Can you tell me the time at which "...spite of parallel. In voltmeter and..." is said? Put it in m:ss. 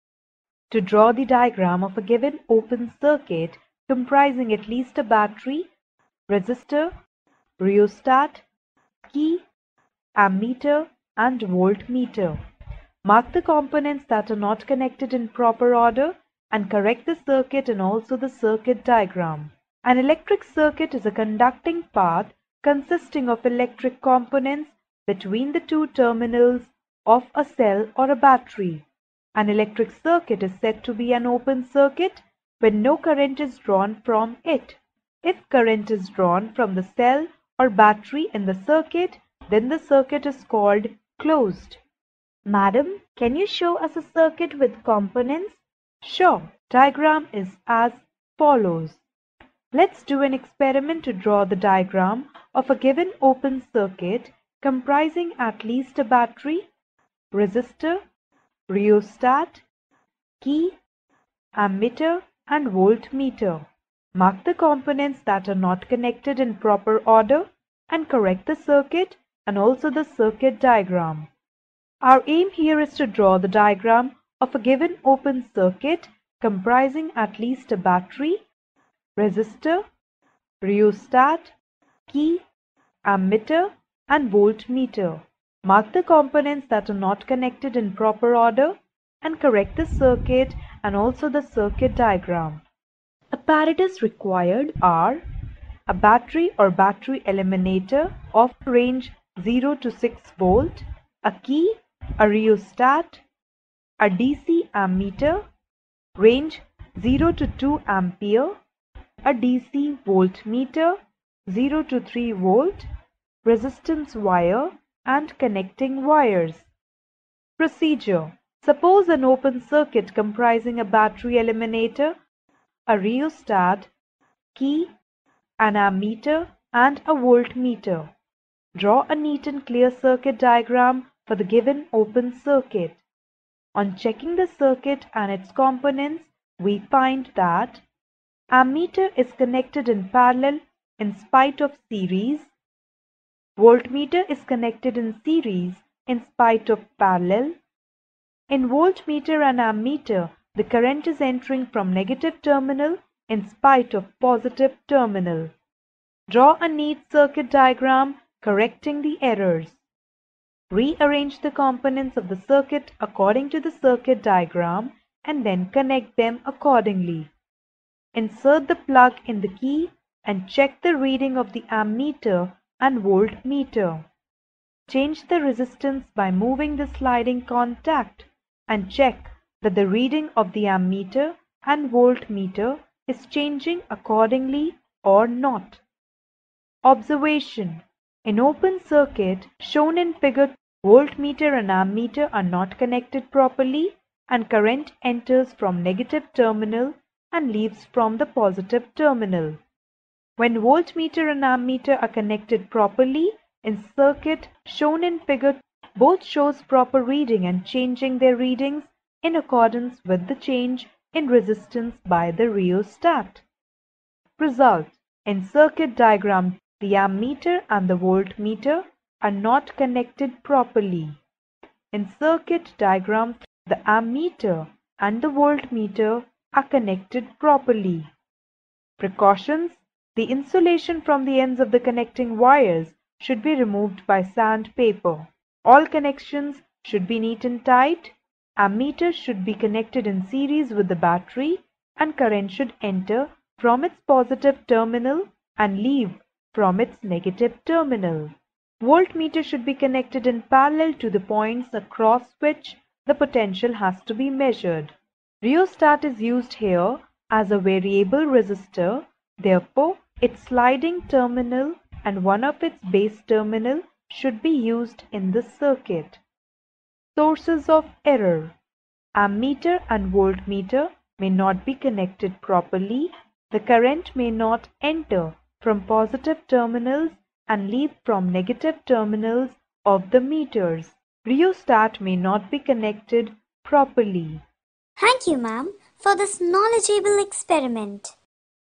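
2:26.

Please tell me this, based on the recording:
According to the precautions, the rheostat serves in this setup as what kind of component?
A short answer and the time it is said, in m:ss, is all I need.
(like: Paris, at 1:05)
Variable resistor, at 4:17.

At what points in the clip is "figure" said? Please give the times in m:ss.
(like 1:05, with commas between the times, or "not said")
3:10, 3:25.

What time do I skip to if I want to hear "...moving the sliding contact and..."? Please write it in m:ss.
2:56.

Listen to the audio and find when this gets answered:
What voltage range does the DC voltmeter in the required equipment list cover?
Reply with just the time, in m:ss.
1:51.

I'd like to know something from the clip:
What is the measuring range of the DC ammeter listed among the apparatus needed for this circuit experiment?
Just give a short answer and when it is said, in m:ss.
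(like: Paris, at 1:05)
0 to 2 ampere, at 1:46.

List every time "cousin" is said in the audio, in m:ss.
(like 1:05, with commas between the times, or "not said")
not said.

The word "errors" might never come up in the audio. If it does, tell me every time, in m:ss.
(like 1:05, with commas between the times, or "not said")
2:39, 4:28.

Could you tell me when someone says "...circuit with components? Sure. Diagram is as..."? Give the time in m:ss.
0:44.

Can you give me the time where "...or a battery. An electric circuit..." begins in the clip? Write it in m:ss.
0:27.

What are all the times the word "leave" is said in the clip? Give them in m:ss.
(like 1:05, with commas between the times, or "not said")
3:17, 4:05, 4:37.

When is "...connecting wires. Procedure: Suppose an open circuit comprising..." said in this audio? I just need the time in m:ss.
1:55.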